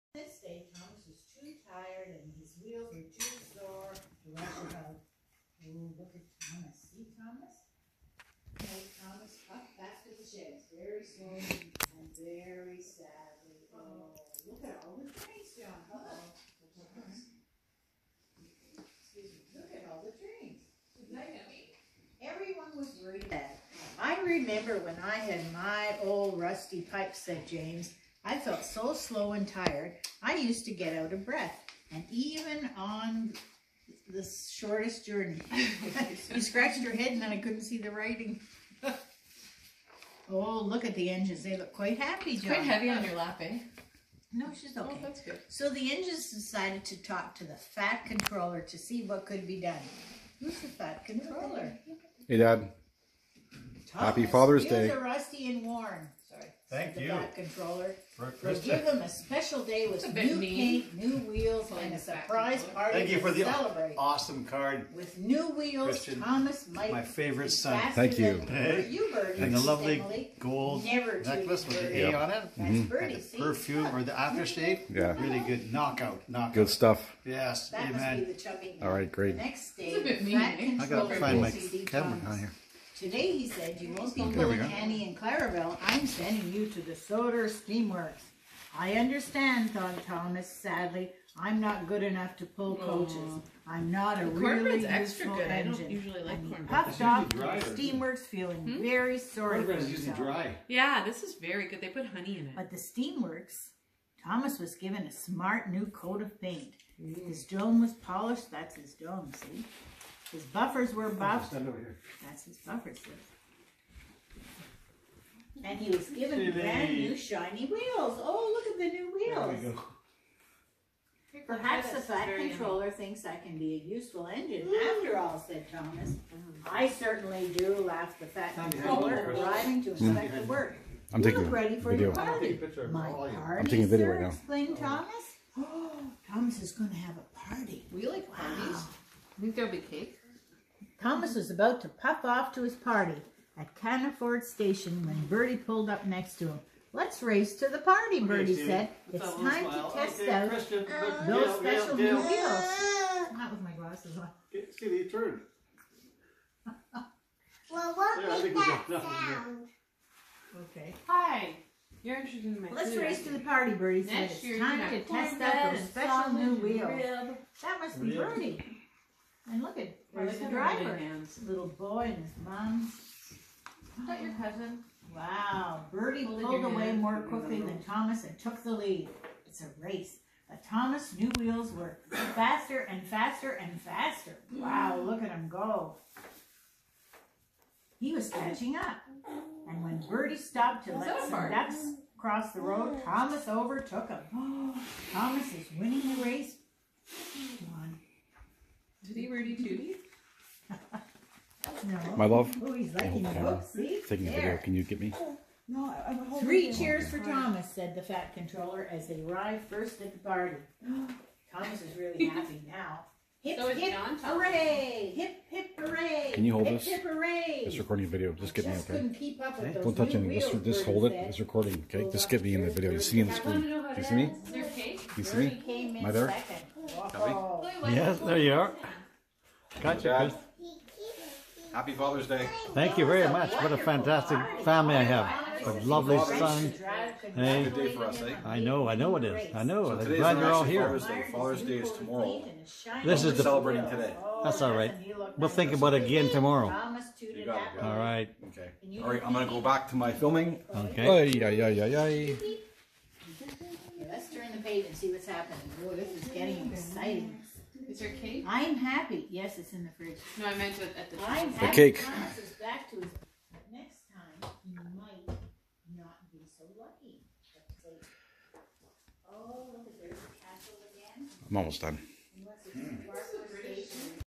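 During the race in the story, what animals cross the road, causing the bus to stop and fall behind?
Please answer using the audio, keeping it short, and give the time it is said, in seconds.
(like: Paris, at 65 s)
ducks, at 191 s.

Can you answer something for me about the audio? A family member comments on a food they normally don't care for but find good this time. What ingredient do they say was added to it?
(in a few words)
honey.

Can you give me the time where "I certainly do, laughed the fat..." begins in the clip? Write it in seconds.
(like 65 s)
126 s.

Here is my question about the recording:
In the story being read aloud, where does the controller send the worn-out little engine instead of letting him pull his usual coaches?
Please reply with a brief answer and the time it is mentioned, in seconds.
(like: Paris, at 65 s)
Sodor Steamworks, at 86 s.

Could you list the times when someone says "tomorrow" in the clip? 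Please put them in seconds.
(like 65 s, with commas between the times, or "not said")
241 s, 246 s.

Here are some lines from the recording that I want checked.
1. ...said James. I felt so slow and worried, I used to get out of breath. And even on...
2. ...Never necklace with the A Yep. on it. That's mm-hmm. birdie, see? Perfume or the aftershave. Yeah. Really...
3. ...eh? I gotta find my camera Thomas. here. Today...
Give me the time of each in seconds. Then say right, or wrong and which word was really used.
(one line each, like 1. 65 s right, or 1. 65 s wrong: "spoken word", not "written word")
1. 27 s wrong: "tired", not "worried"
2. 70 s right
3. 80 s right.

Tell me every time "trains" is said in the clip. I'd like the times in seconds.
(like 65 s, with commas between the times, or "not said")
15 s, 20 s.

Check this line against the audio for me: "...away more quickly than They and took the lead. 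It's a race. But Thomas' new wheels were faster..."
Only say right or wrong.
wrong.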